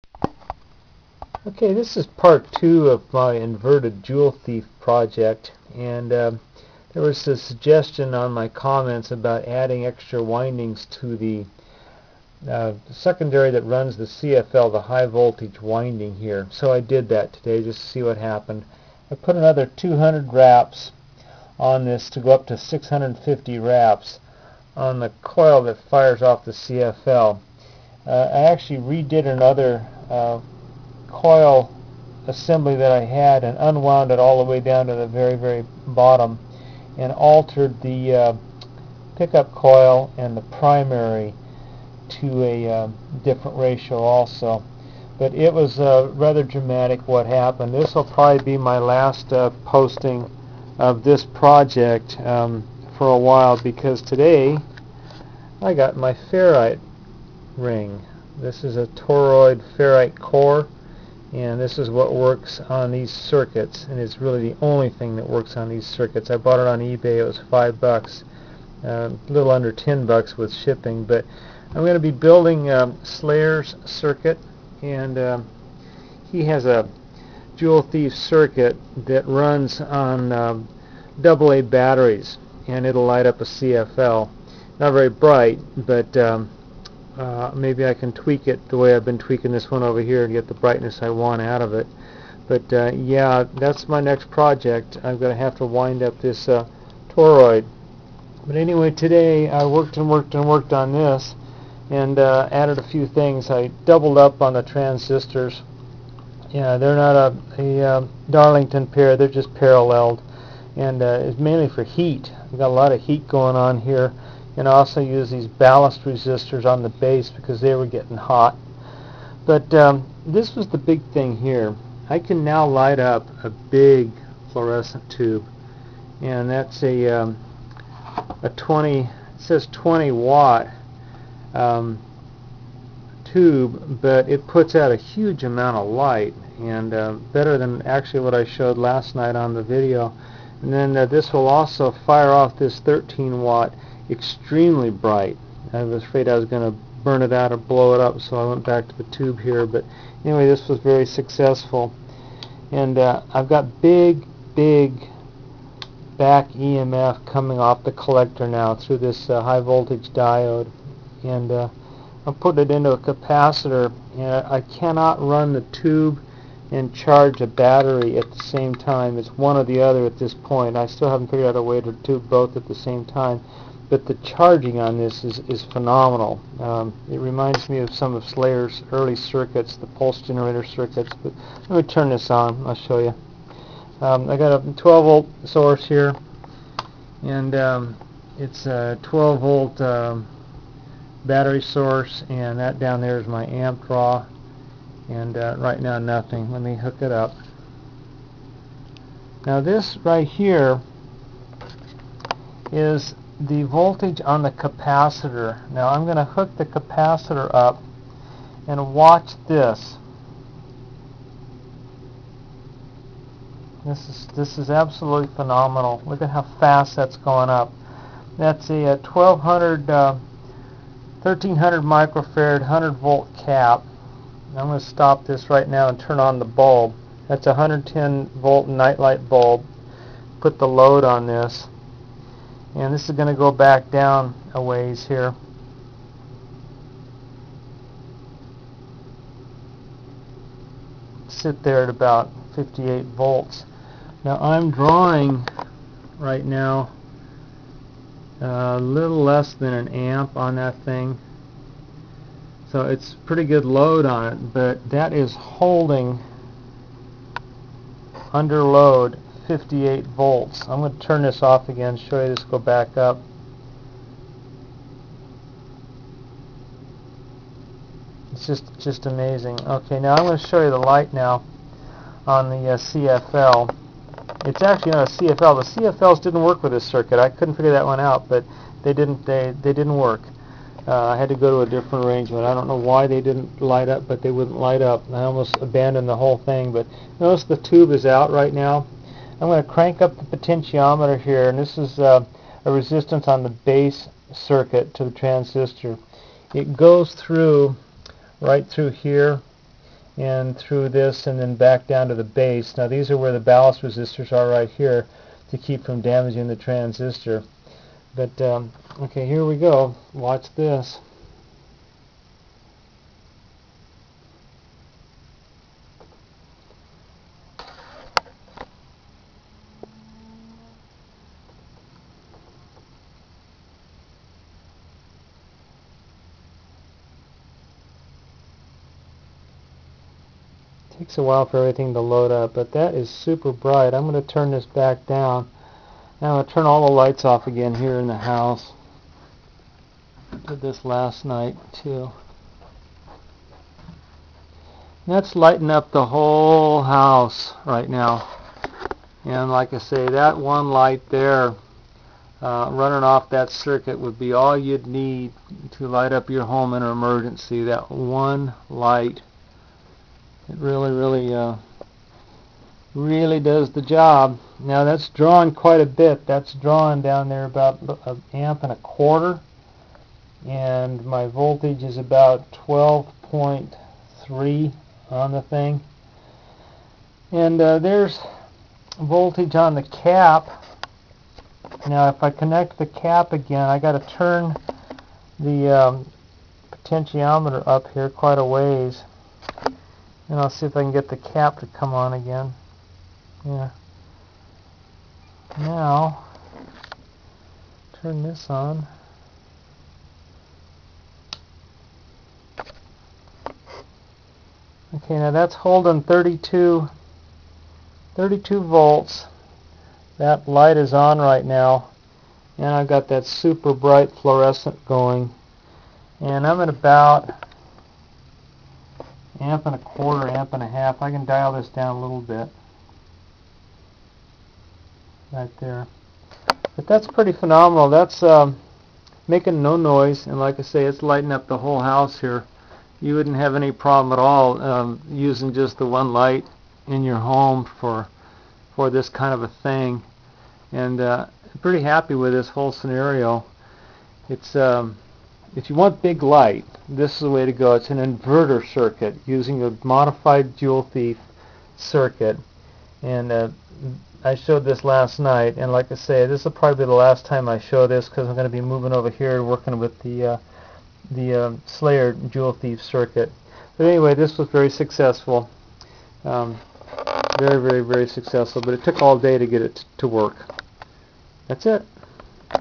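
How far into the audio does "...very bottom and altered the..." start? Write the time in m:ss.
0:35.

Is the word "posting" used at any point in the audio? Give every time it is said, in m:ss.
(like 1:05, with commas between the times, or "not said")
0:49.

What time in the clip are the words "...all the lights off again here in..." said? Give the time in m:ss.
5:36.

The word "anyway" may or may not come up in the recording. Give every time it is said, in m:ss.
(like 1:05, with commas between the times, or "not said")
1:38, 2:30, 7:43.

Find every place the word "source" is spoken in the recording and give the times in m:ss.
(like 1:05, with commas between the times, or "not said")
3:05, 3:11.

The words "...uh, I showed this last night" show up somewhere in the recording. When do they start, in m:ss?
7:33.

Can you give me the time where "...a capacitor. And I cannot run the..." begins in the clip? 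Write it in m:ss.
2:42.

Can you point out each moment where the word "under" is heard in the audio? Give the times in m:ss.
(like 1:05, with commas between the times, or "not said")
1:09, 4:18.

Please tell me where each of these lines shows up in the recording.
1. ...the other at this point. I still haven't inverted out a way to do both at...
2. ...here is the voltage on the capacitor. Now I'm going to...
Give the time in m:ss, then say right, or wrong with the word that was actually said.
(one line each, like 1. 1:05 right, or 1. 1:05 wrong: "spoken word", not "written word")
1. 2:49 wrong: "figured", not "inverted"
2. 3:20 right.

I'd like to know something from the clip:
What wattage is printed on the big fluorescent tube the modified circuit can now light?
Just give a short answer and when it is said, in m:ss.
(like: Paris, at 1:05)
20 watt, at 2:09.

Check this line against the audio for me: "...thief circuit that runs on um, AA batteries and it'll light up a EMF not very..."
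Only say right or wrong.
wrong.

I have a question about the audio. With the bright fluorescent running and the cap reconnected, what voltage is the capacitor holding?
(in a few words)
32 volts.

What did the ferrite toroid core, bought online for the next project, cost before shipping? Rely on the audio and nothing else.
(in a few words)
5 dollars.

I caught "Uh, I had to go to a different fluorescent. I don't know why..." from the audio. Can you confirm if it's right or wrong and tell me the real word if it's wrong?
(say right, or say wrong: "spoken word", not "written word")
wrong: "arrangement", not "fluorescent".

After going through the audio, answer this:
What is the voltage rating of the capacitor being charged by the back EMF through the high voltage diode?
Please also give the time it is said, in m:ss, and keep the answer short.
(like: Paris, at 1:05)
100 volt, at 3:42.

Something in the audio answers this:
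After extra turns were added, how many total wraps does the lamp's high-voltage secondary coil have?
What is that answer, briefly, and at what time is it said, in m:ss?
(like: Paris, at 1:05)
650, at 0:22.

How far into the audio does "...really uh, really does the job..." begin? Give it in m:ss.
6:00.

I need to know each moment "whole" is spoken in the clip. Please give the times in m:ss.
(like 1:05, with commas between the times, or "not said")
4:46, 5:46, 7:11, 7:22.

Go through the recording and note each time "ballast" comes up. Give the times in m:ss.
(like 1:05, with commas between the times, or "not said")
1:55, 5:03.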